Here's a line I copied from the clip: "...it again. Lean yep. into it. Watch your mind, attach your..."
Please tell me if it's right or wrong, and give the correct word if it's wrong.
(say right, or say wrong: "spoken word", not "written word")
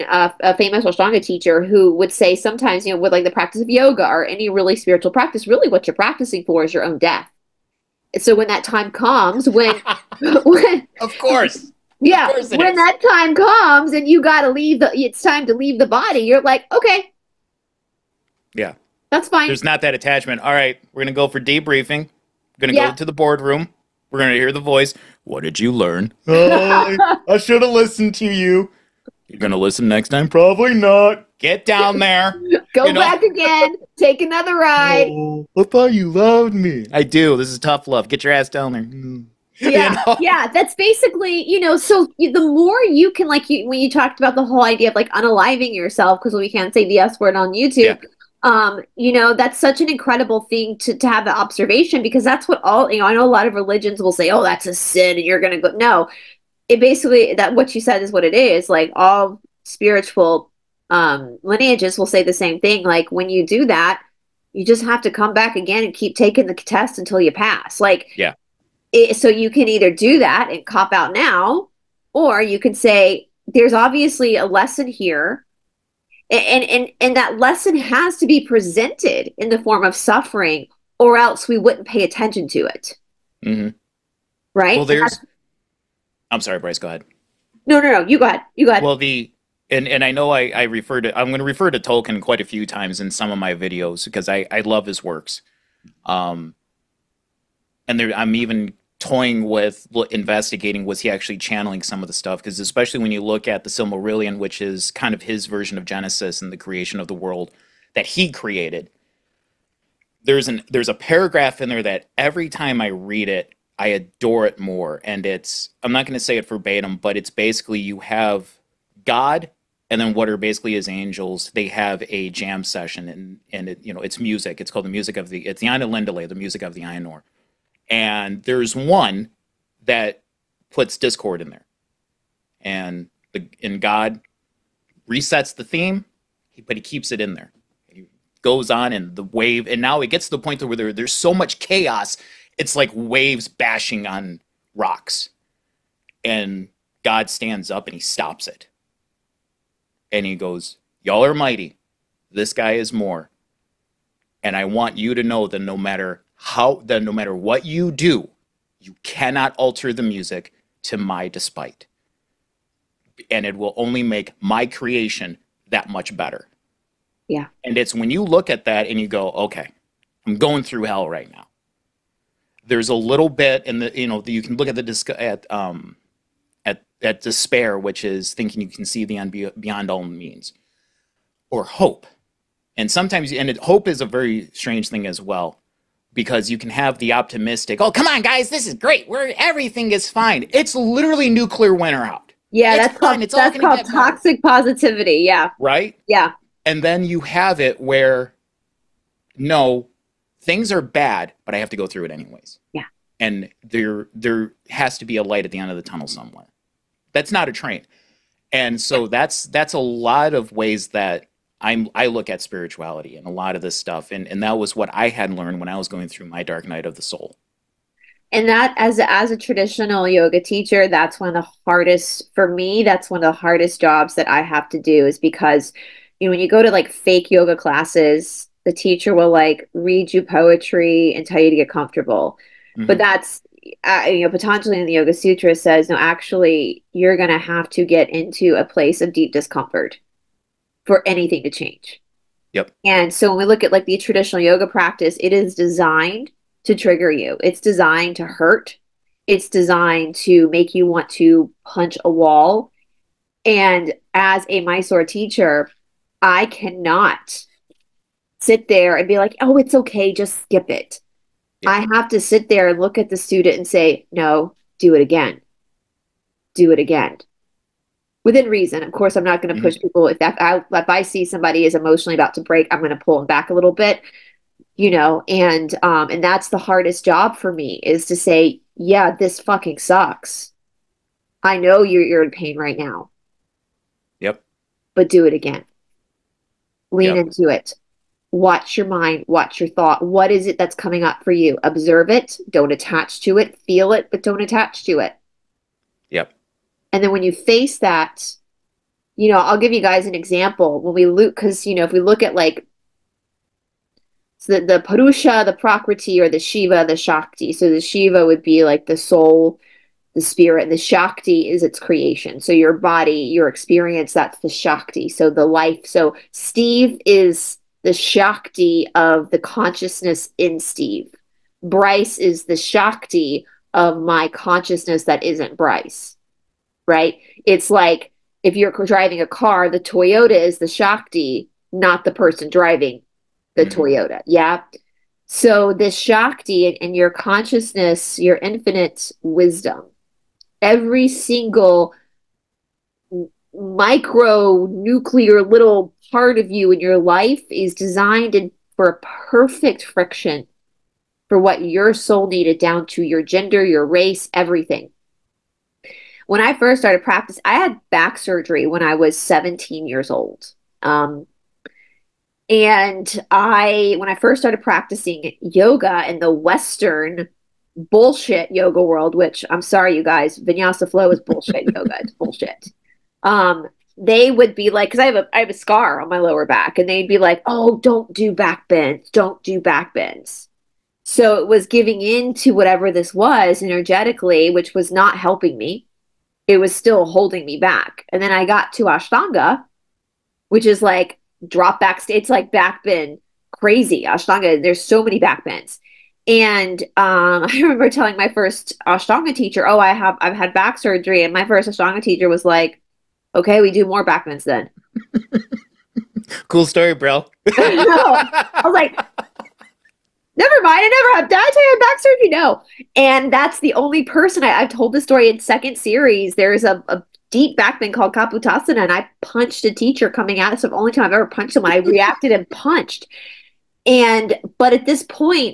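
wrong: "watch", not "attach".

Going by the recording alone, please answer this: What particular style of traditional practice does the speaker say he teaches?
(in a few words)
Mysore teacher.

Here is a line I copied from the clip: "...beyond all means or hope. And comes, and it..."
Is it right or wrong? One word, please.
wrong.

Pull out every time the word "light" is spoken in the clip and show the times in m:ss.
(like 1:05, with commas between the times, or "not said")
3:25.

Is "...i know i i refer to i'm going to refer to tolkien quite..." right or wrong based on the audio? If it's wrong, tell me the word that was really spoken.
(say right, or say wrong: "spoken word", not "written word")
right.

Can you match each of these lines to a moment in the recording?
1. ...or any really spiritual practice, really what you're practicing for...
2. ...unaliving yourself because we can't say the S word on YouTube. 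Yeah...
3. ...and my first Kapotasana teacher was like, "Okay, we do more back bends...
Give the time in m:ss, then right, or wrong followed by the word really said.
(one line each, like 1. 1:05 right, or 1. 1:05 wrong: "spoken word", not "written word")
1. 0:04 right
2. 0:45 right
3. 6:41 wrong: "Ashtanga", not "Kapotasana".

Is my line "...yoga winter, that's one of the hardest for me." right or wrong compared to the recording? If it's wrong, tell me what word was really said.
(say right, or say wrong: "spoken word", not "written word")
wrong: "teacher", not "winter".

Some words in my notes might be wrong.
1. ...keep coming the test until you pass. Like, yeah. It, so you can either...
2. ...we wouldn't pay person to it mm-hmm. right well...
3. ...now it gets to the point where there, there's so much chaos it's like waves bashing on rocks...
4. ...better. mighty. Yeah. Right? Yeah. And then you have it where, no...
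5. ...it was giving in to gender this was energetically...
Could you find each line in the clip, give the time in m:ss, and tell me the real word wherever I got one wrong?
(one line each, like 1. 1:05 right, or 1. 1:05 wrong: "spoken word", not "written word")
1. 1:05 wrong: "taking", not "coming"
2. 1:21 wrong: "attention", not "person"
3. 2:19 right
4. 3:14 wrong: "positivity", not "mighty"
5. 6:21 wrong: "whatever", not "gender".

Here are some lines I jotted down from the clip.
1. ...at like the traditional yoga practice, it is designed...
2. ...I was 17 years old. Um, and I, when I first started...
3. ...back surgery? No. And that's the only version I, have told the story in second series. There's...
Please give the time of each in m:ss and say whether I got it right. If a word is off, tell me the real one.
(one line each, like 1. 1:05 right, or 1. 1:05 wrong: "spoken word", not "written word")
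1. 4:03 right
2. 5:58 right
3. 6:51 wrong: "person", not "version".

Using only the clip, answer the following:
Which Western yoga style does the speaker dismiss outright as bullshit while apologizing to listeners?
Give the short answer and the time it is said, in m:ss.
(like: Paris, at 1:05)
Vinyasa flow, at 6:10.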